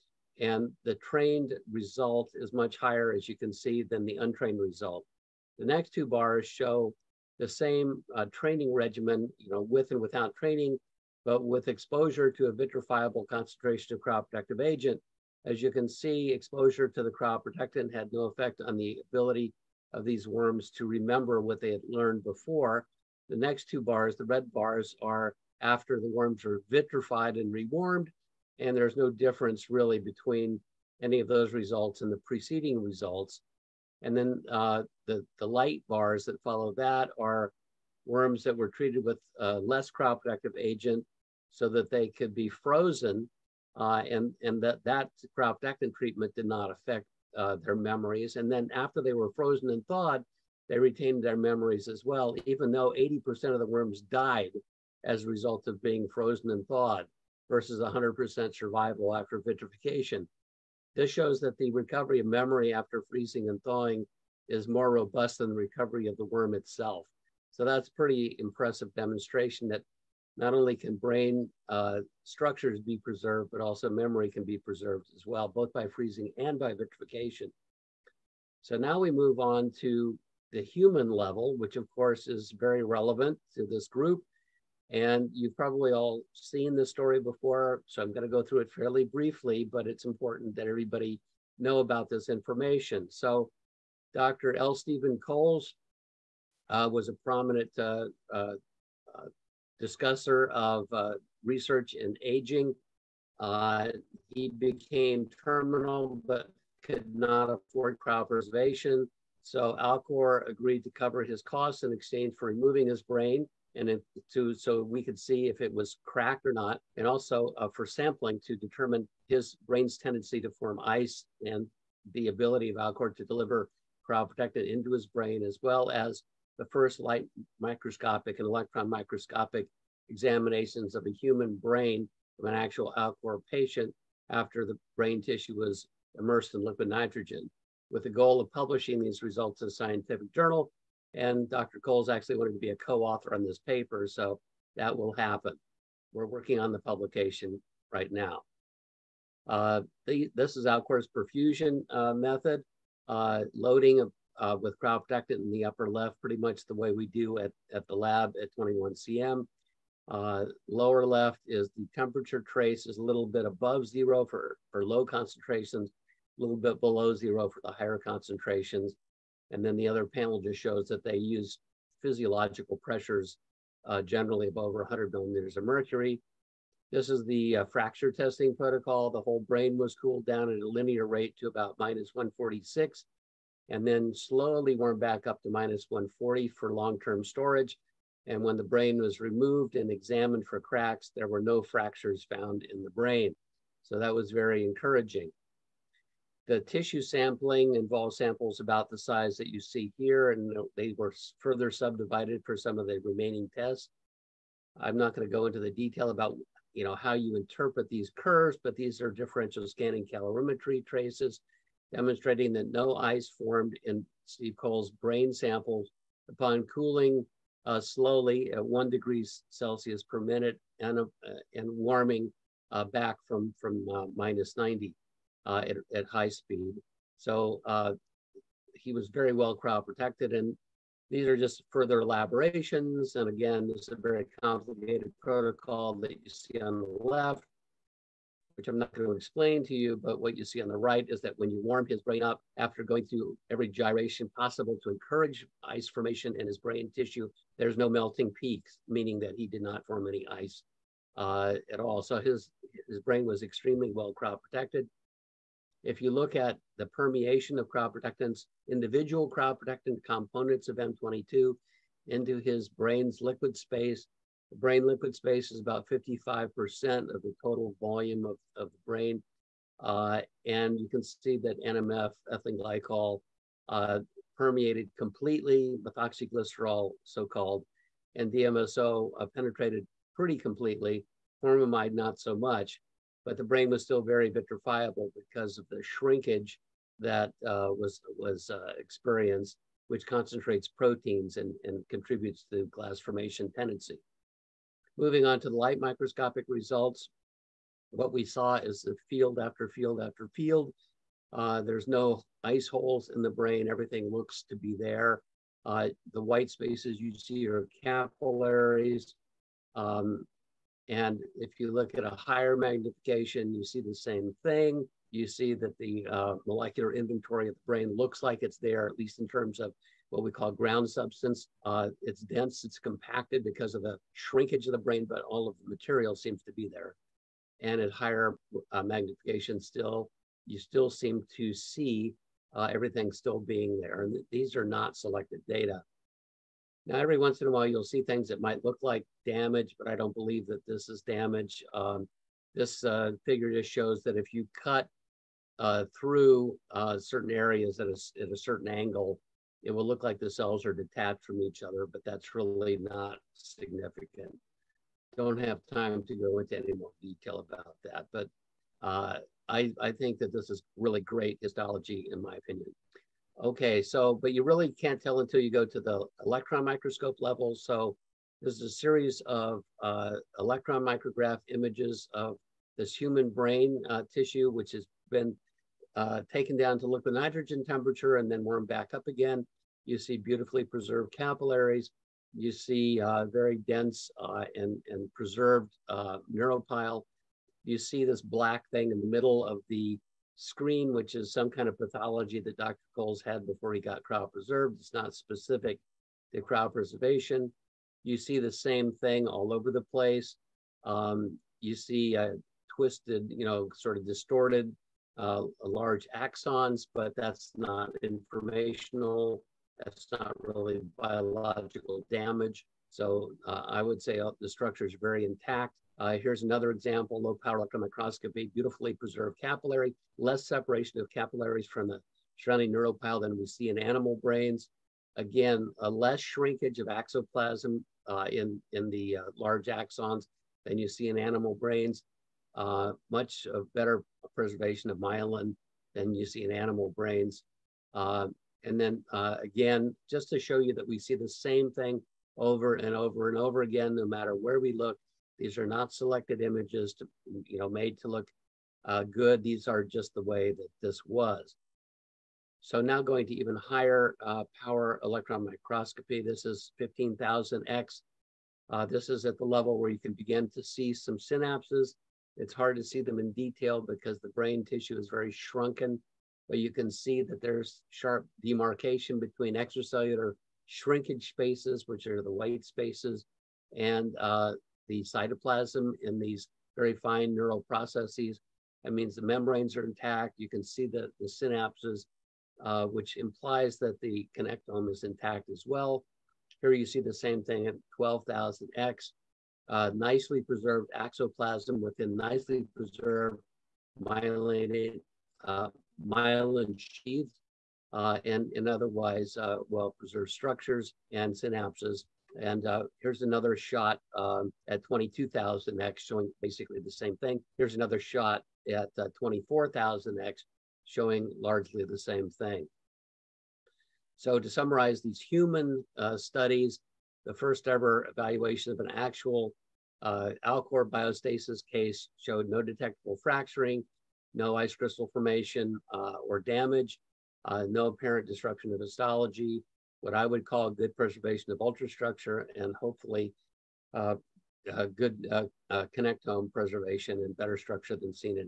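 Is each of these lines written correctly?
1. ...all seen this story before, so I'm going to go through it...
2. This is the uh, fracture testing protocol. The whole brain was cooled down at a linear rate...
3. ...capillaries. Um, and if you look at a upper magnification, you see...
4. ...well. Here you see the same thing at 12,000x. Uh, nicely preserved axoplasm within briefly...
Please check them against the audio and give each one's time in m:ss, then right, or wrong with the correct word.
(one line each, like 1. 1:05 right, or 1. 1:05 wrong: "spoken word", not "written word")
1. 1:25 right
2. 2:56 right
3. 5:07 wrong: "higher", not "upper"
4. 8:05 wrong: "nicely", not "briefly".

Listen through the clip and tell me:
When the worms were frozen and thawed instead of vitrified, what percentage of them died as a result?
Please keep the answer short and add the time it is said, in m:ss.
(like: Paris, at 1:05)
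80%, at 0:52.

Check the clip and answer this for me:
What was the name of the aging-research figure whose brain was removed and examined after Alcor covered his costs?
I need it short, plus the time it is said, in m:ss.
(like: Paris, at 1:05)
L. Stephen Coles, at 1:34.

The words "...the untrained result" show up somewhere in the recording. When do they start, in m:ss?
0:04.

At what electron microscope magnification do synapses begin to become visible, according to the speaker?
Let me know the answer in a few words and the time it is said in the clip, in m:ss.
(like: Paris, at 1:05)
15,000x, at 7:36.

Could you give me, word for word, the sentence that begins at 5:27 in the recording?
And at higher uh, magnification, still, you still seem to see uh, everything still being there.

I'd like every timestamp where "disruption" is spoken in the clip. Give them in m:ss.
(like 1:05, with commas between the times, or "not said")
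8:48.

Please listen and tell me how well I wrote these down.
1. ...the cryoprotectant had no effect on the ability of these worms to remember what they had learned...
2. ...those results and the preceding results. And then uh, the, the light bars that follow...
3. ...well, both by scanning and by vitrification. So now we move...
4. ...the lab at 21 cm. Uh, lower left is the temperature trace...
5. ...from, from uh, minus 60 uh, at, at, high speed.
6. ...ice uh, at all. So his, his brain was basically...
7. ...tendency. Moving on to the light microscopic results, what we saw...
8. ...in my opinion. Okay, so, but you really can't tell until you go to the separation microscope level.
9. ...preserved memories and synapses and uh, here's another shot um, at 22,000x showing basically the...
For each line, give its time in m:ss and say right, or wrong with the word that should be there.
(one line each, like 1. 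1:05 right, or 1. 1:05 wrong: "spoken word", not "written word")
1. 0:17 right
2. 0:31 right
3. 1:15 wrong: "freezing", not "scanning"
4. 2:37 right
5. 3:43 wrong: "90", not "60"
6. 4:10 wrong: "extremely", not "basically"
7. 4:53 right
8. 6:02 wrong: "electron", not "separation"
9. 8:19 wrong: "structures", not "memories".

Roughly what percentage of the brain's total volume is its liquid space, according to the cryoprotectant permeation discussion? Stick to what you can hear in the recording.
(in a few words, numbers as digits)
55%.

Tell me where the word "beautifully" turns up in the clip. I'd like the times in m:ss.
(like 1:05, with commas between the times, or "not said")
6:20, 6:58.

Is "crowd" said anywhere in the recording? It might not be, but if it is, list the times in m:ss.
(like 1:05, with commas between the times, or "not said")
4:14.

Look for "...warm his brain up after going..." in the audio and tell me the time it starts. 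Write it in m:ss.
4:01.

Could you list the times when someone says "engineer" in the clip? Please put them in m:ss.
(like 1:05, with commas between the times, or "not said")
not said.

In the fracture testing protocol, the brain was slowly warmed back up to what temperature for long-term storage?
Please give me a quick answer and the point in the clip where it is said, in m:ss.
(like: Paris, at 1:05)
-140, at 3:05.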